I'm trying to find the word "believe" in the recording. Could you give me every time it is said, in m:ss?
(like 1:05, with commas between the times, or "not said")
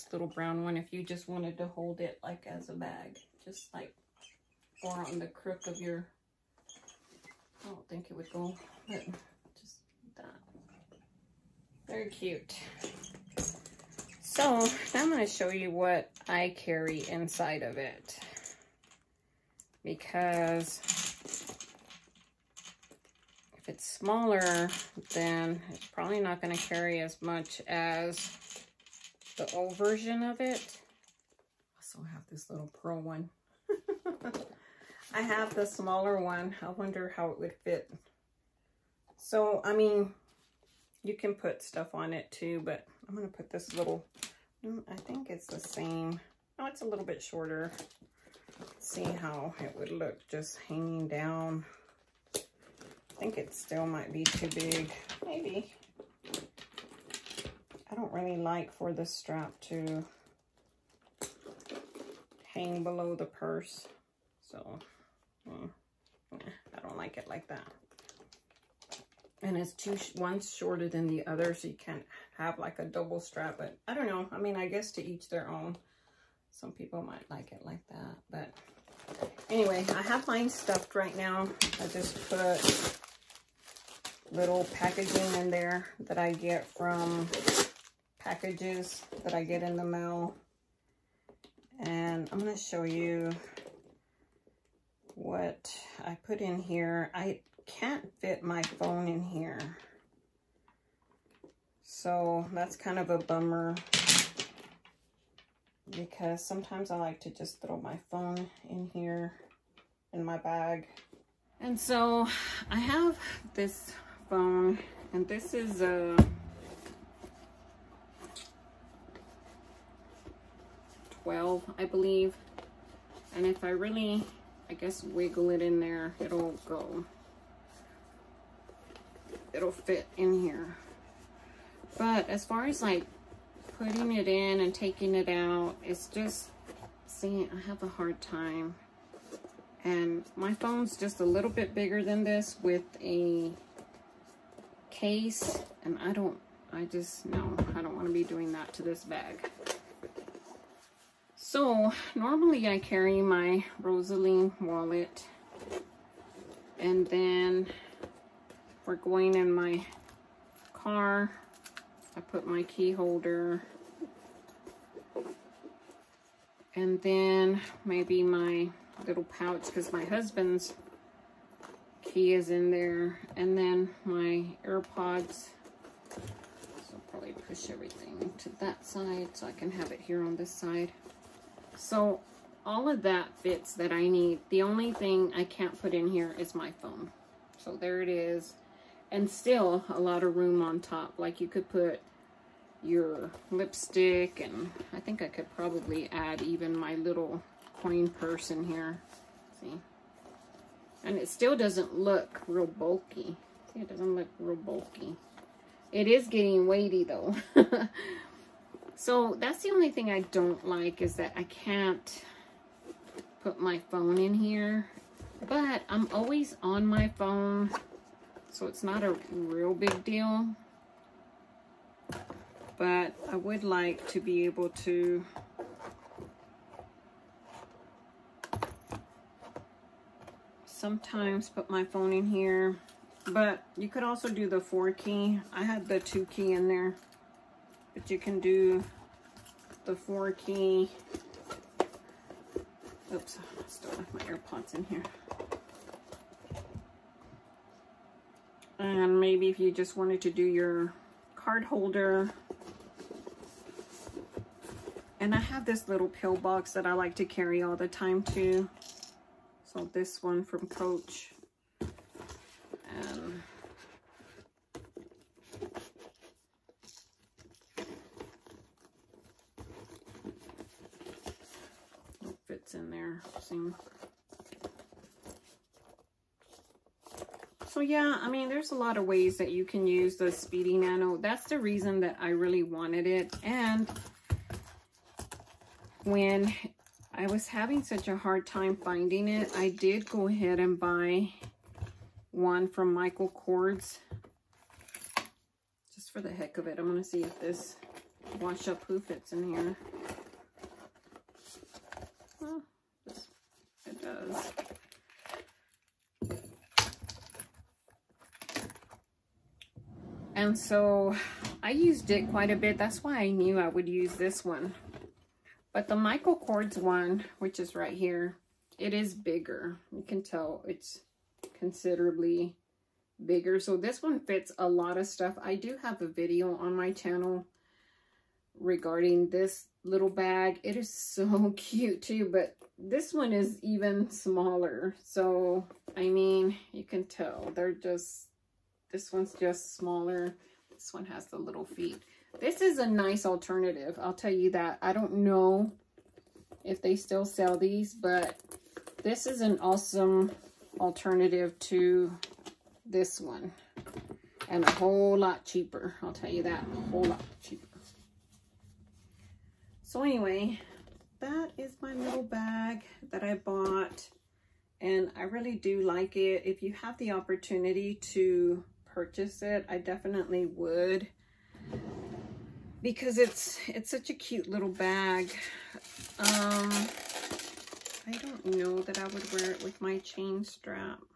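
2:01.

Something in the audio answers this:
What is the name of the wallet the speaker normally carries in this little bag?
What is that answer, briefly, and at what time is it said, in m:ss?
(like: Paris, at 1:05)
Rosaline, at 2:33.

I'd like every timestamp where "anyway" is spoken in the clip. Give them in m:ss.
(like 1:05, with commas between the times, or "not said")
1:19, 6:00.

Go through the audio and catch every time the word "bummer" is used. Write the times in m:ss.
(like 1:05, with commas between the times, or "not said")
1:43.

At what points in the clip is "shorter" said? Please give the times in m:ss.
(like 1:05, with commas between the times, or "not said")
0:47, 1:10.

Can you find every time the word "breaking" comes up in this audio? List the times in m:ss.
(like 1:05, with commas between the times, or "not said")
not said.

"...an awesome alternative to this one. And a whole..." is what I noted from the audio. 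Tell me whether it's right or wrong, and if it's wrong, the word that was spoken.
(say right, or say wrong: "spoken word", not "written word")
right.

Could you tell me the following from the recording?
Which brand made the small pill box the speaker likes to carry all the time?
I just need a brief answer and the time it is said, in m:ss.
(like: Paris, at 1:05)
Coach, at 4:20.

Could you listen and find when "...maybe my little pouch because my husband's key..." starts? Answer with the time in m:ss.
2:47.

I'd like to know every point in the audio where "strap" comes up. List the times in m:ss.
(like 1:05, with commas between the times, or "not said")
0:59, 1:13, 6:20.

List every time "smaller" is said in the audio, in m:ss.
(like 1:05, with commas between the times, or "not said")
0:23, 0:35, 5:34, 5:39.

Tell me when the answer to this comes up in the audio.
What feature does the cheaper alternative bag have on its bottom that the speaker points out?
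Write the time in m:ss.
5:41.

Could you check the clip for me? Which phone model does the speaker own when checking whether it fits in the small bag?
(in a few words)
12.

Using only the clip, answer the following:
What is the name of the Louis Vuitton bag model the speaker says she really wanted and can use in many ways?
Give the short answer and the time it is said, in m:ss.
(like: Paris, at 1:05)
Speedy Nano, at 4:40.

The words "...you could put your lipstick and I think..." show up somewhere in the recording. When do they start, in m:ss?
3:11.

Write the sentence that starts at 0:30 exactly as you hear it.
I also have this little pearl one.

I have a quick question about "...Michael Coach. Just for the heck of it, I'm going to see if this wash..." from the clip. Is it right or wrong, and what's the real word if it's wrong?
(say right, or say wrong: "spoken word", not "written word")
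wrong: "Kors", not "Coach".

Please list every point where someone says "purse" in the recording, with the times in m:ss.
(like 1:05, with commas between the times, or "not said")
1:03, 3:18.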